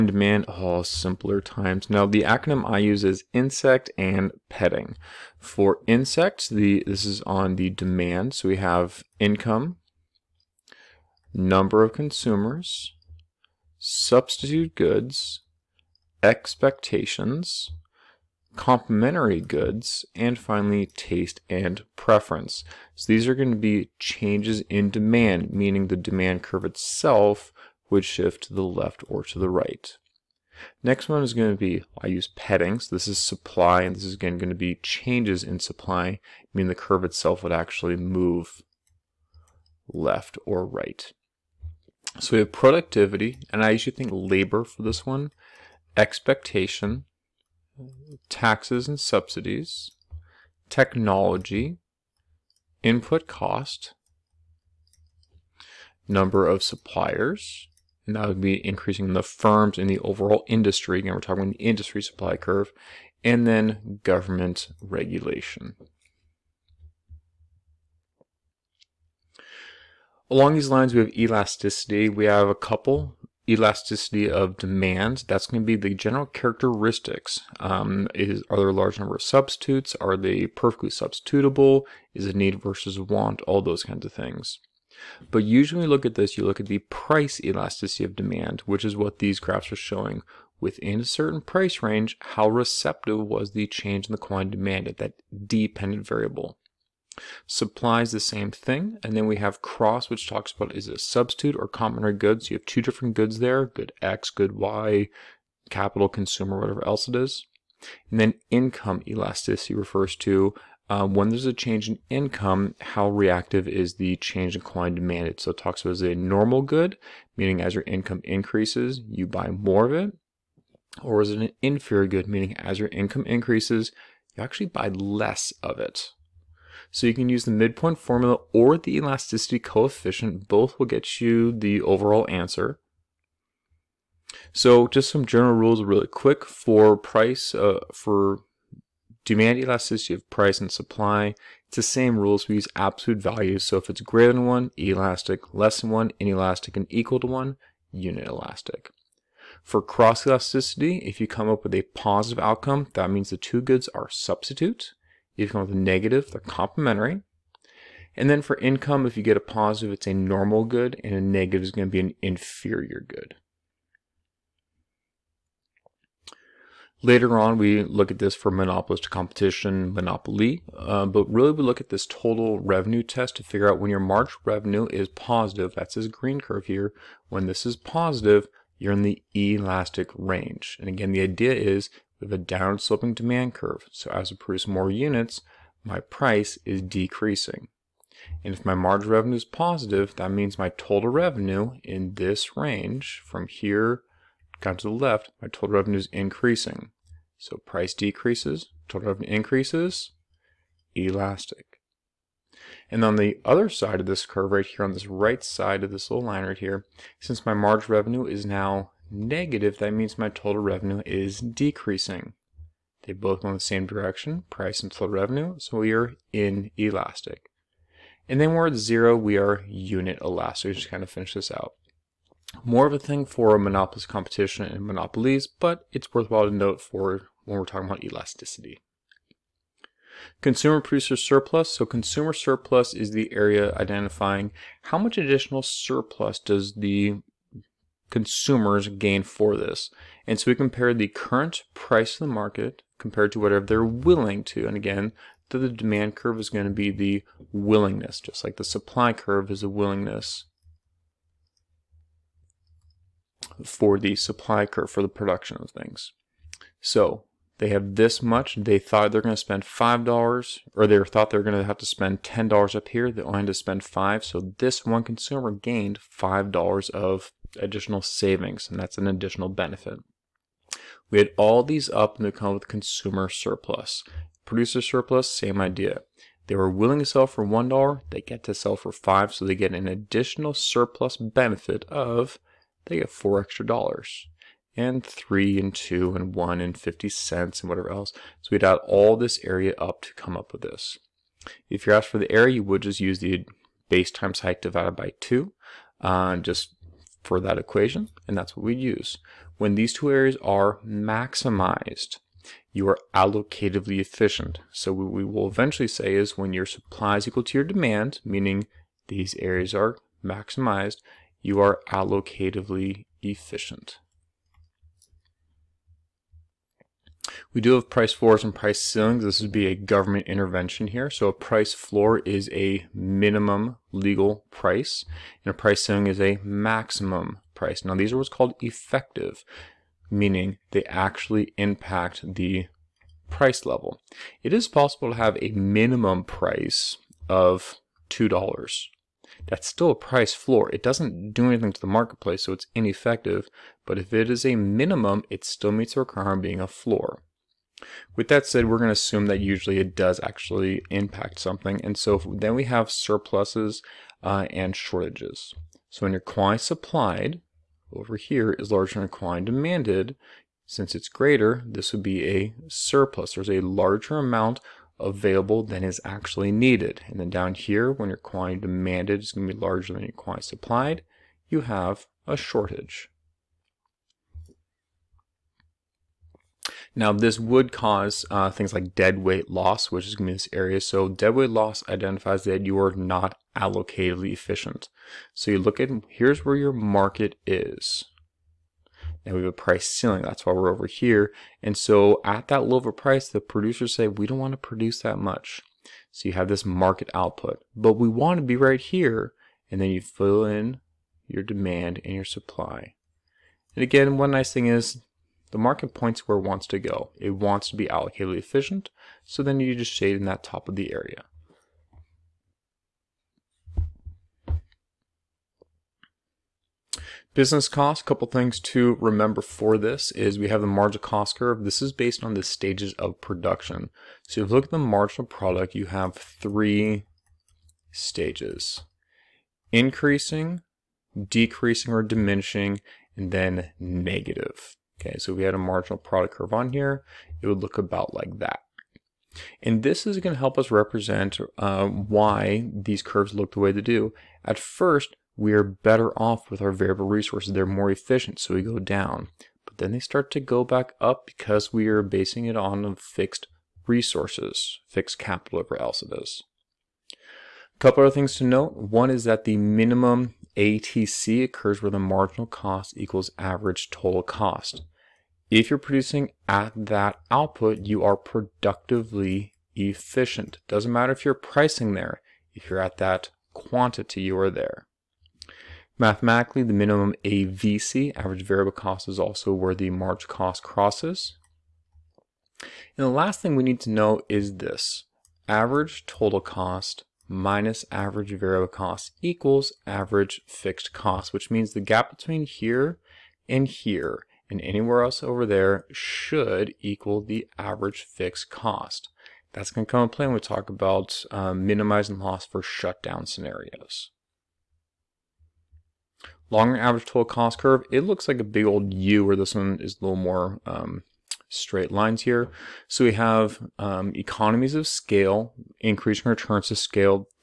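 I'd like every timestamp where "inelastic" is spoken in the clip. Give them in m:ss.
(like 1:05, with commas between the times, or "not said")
2:26, 3:36.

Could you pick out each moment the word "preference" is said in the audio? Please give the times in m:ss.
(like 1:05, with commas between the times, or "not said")
0:21.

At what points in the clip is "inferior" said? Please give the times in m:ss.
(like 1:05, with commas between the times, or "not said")
2:01, 2:42.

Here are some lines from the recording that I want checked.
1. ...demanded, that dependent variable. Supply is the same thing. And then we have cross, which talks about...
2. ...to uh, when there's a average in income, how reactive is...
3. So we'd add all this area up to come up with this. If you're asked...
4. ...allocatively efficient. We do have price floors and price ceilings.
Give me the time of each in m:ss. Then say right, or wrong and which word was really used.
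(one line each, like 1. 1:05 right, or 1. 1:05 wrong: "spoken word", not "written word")
1. 1:34 right
2. 1:50 wrong: "change", not "average"
3. 4:48 right
4. 5:11 right.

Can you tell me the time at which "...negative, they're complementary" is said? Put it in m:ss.
2:35.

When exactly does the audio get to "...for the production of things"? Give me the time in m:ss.
4:14.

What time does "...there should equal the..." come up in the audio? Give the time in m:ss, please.
8:15.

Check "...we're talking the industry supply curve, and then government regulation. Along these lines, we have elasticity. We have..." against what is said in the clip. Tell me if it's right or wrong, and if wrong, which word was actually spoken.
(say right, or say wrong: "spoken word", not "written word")
right.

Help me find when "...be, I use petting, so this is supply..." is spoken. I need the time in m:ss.
0:31.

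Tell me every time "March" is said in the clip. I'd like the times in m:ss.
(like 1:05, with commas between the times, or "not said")
2:53, 7:59.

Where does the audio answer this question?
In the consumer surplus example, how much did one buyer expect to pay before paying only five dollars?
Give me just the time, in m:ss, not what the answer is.
4:22.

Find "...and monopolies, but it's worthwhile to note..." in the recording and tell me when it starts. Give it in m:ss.
3:44.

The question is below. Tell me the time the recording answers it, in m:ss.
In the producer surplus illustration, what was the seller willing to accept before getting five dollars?
4:37.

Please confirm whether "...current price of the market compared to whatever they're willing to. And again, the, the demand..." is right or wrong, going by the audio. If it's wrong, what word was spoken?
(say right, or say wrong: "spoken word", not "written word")
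right.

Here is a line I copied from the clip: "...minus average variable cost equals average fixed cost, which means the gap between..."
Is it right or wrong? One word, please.
right.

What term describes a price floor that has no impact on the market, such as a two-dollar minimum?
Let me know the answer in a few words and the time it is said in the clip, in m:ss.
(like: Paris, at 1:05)
ineffective, at 5:42.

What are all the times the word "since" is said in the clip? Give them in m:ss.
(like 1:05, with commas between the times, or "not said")
3:27, 6:00.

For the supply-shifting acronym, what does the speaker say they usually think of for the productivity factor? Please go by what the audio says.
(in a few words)
labor.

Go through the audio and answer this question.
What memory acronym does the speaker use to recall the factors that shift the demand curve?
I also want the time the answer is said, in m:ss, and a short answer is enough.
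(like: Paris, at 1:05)
insect, at 0:03.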